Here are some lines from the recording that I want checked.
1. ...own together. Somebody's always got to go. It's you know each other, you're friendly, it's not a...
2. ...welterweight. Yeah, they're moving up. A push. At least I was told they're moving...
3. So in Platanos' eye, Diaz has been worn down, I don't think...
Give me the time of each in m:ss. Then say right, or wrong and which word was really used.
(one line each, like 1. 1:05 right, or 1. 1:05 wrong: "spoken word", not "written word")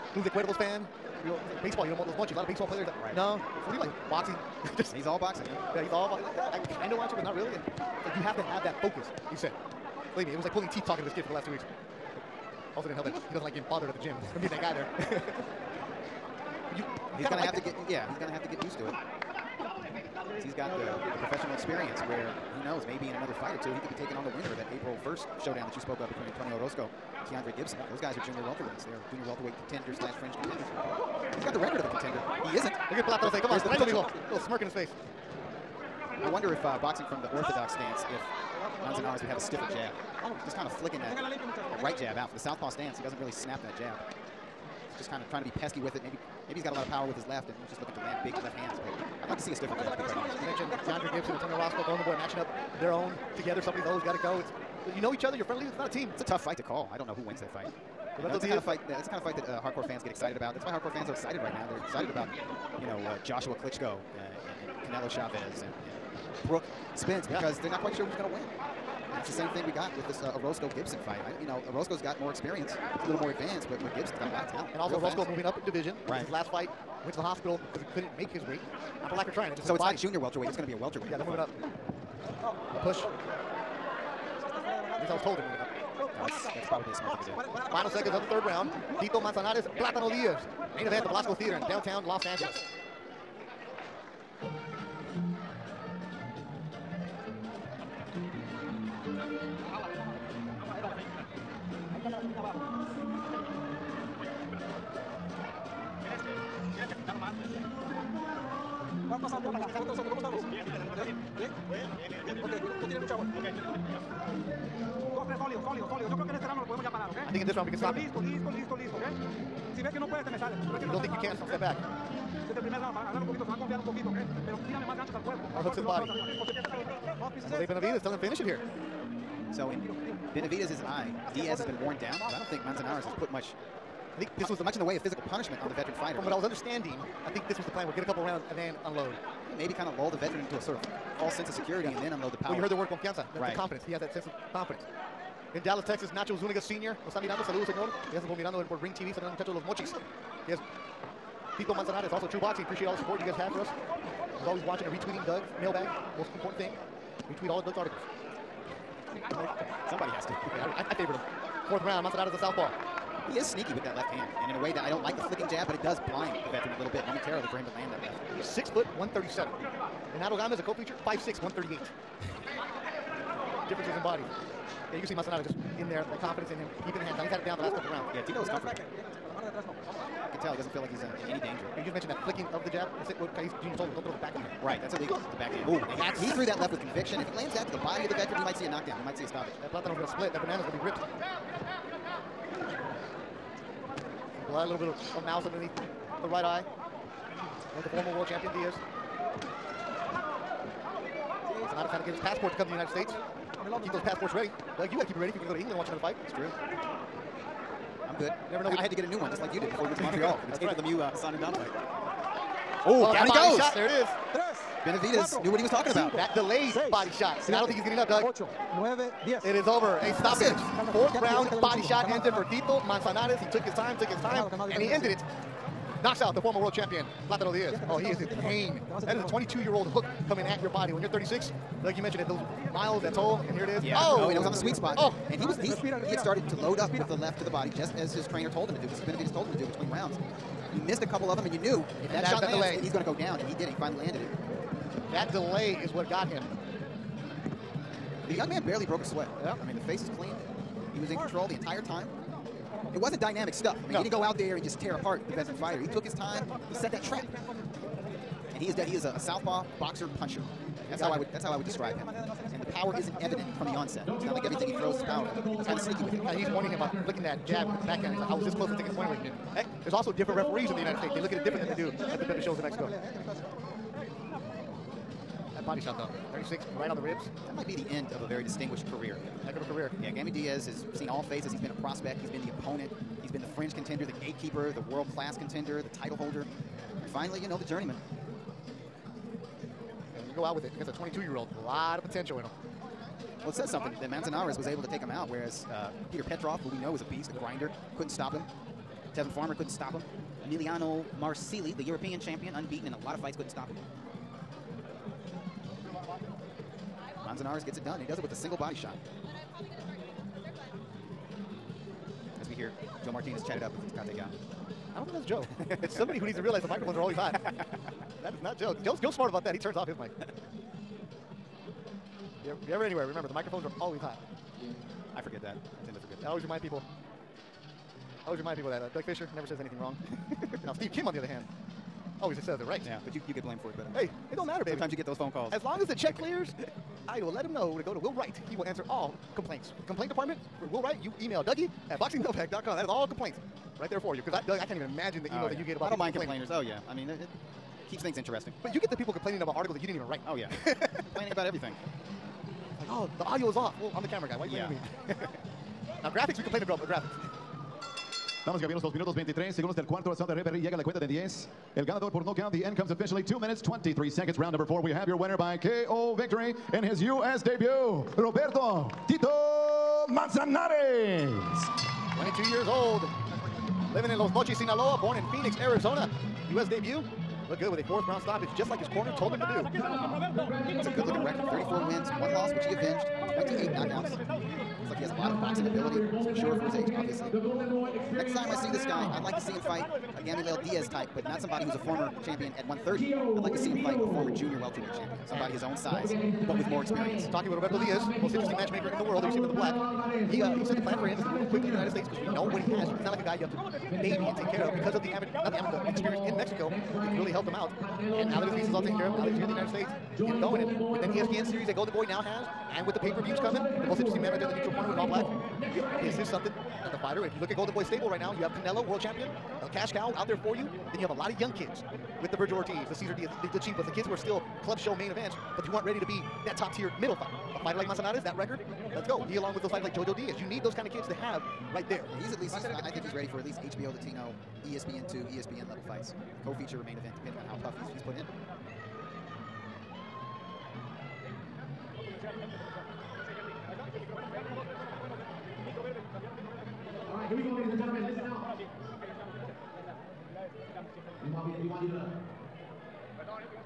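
1. 0:52 right
2. 1:20 right
3. 2:09 wrong: "Benavides", not "Platanos".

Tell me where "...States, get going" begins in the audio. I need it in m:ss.
6:49.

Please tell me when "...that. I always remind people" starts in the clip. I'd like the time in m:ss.
5:26.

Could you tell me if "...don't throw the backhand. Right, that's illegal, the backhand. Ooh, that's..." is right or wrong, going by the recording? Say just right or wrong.
right.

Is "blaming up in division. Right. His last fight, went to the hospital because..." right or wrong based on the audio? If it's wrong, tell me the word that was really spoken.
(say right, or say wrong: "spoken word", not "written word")
wrong: "moving", not "blaming".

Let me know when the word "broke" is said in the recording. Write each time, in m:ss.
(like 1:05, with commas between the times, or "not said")
4:08.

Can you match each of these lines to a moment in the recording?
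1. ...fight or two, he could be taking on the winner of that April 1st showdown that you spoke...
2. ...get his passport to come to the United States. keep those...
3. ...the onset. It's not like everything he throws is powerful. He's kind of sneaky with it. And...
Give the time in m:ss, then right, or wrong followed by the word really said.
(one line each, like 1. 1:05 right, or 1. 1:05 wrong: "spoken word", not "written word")
1. 0:23 right
2. 3:22 right
3. 4:23 right.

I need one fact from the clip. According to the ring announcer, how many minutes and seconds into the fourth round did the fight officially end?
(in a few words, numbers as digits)
2 minutes 23 seconds.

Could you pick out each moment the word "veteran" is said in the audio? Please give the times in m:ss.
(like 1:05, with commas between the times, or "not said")
2:15, 2:20, 2:46, 3:08, 4:15.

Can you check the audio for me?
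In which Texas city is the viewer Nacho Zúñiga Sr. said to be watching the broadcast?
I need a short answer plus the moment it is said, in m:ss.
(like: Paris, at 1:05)
Dallas, at 2:25.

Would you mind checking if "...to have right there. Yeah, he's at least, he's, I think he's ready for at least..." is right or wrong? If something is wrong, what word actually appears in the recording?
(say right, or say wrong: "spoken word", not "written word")
right.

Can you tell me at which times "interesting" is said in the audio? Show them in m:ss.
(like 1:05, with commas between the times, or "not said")
5:48, 6:38, 6:54.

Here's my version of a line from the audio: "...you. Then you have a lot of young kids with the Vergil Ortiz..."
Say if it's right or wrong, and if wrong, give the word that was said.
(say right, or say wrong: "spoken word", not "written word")
right.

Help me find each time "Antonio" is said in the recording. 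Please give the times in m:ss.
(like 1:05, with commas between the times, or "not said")
0:26, 0:51.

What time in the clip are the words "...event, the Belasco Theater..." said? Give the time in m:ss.
1:30.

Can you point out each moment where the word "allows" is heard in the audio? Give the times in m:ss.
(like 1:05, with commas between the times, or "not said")
not said.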